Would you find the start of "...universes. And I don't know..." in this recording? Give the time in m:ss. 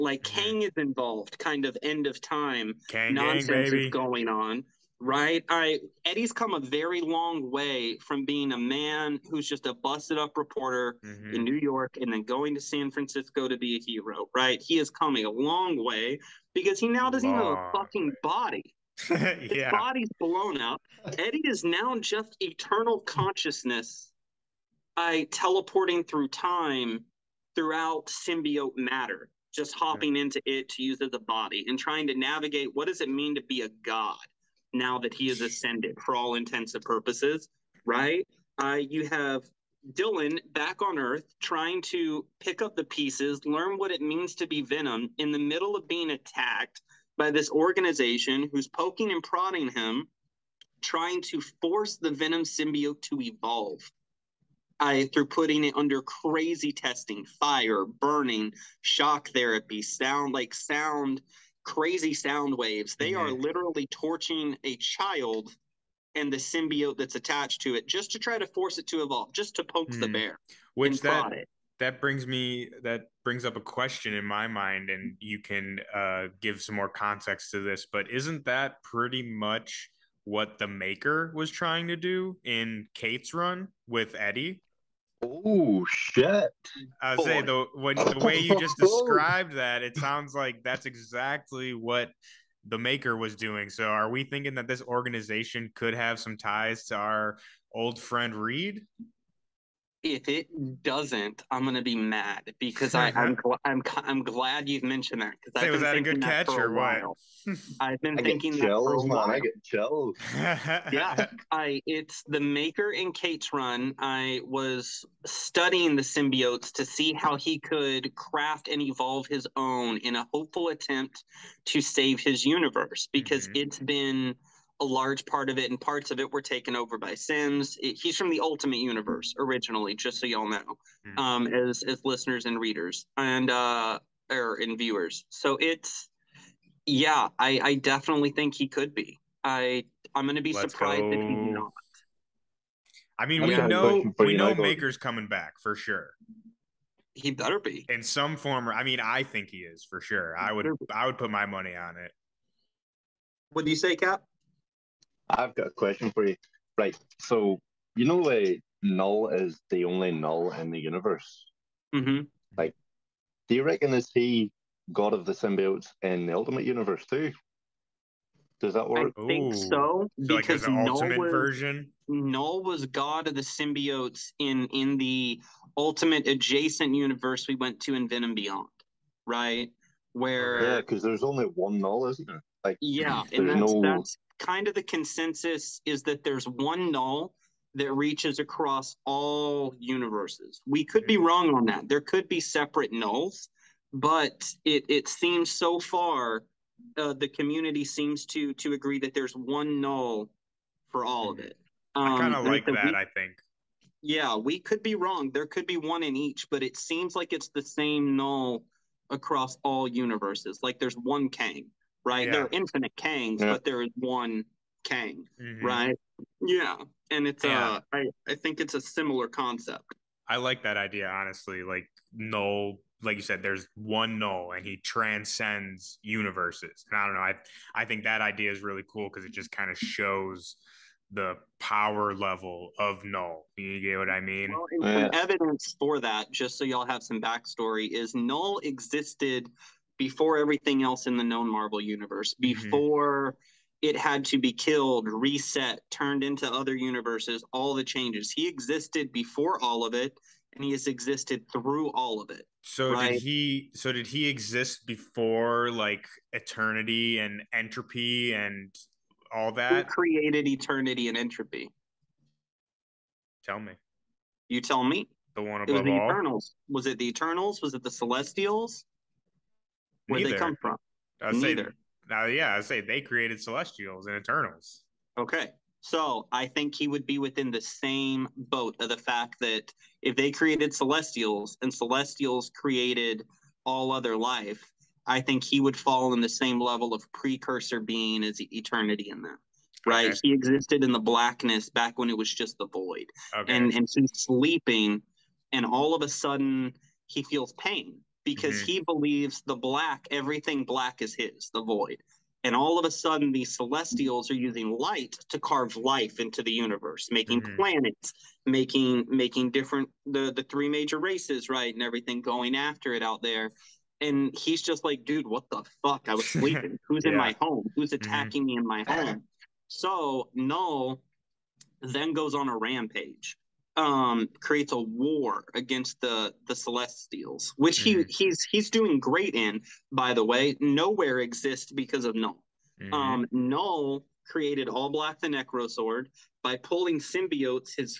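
3:46.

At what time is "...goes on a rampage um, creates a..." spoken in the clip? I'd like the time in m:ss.
5:22.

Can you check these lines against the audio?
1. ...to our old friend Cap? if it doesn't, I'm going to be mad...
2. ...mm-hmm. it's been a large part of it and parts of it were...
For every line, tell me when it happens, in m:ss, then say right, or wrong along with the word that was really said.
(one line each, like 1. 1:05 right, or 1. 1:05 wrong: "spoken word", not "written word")
1. 1:36 wrong: "Reed", not "Cap"
2. 2:03 right.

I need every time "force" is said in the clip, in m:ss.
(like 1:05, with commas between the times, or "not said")
0:51, 1:08.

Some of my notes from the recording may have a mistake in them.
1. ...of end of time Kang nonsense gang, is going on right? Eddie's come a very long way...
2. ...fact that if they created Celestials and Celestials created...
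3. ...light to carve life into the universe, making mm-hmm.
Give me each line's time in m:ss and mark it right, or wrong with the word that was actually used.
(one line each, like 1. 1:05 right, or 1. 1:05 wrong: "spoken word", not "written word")
1. 0:01 right
2. 4:38 right
3. 5:04 right.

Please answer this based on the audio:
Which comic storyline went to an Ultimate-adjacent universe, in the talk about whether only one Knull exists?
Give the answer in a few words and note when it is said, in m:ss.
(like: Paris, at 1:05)
Venom Beyond, at 2:58.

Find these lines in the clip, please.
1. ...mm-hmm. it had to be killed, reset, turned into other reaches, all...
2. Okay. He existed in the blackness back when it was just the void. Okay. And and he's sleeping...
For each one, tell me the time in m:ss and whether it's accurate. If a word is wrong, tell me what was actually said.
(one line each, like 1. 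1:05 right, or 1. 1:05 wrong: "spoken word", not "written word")
1. 4:03 wrong: "universes", not "reaches"
2. 4:50 right.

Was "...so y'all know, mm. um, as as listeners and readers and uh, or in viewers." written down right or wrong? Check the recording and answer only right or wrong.
right.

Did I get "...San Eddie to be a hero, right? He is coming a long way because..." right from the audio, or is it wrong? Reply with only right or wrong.
wrong.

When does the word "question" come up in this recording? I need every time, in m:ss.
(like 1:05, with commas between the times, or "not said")
1:13, 2:35.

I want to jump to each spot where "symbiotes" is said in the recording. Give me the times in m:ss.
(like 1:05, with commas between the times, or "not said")
0:28, 0:52, 1:06, 1:56, 2:45, 2:53, 5:36.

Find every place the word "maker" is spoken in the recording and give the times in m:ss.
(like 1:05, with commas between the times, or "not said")
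1:20, 1:32, 1:52, 2:24.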